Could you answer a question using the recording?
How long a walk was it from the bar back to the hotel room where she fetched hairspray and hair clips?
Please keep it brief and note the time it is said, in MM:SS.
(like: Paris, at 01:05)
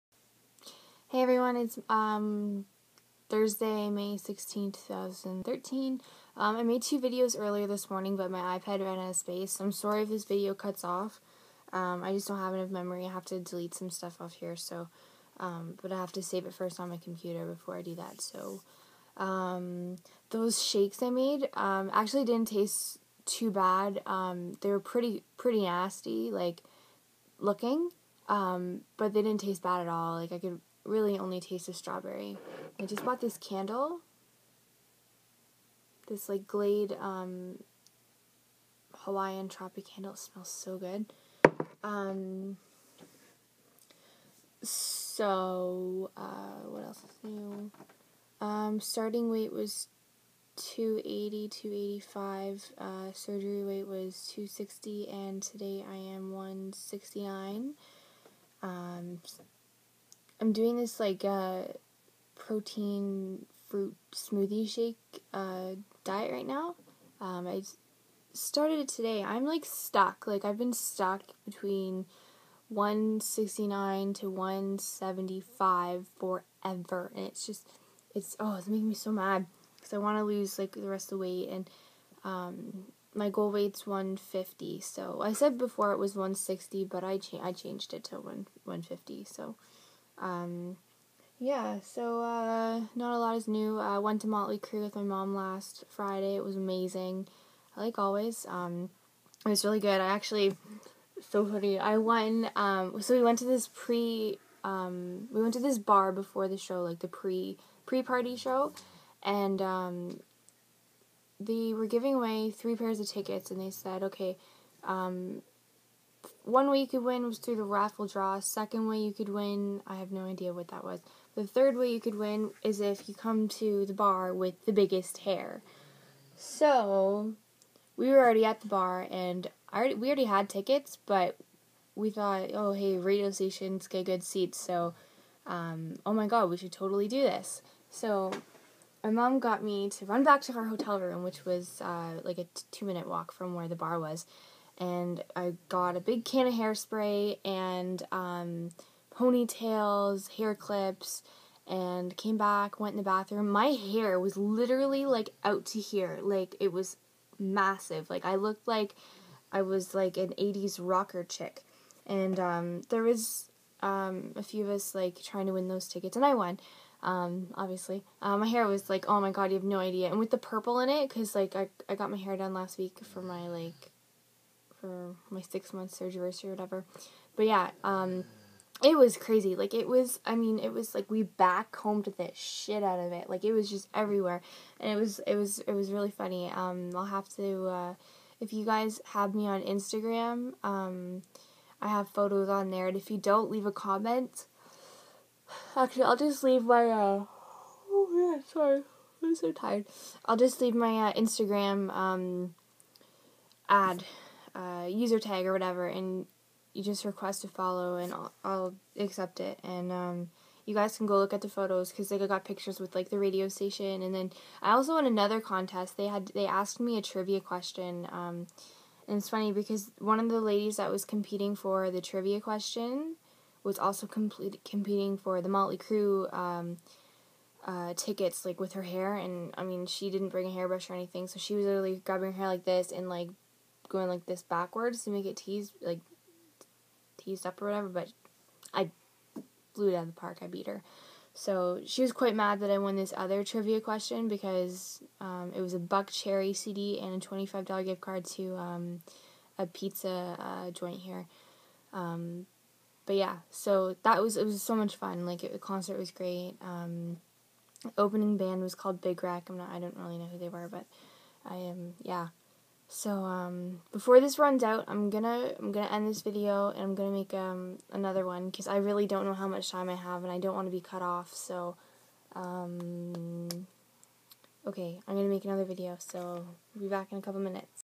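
2 minute, at 02:22.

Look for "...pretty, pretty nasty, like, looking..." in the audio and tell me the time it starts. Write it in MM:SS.
00:24.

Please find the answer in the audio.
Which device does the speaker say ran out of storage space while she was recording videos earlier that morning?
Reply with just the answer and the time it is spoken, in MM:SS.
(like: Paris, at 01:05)
iPad, at 00:08.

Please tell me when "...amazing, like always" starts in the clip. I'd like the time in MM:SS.
01:36.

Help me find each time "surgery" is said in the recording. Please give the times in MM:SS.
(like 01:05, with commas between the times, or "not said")
00:53, 02:55.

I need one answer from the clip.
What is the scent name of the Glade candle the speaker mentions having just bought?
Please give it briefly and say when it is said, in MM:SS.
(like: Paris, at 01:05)
Hawaiian Tropic, at 00:38.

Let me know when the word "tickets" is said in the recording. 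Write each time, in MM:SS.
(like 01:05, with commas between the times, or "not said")
01:53, 02:10, 02:45, 03:47.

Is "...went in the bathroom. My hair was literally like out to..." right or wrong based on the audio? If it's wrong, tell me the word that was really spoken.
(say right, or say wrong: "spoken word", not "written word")
right.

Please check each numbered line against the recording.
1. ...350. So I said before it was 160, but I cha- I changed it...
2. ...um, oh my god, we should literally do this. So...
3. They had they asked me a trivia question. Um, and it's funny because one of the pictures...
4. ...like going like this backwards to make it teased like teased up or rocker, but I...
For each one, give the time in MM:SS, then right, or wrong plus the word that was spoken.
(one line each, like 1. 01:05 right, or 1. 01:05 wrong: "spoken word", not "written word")
1. 01:23 wrong: "150", not "350"
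2. 02:15 wrong: "totally", not "literally"
3. 03:35 wrong: "ladies", not "pictures"
4. 03:53 wrong: "whatever", not "rocker".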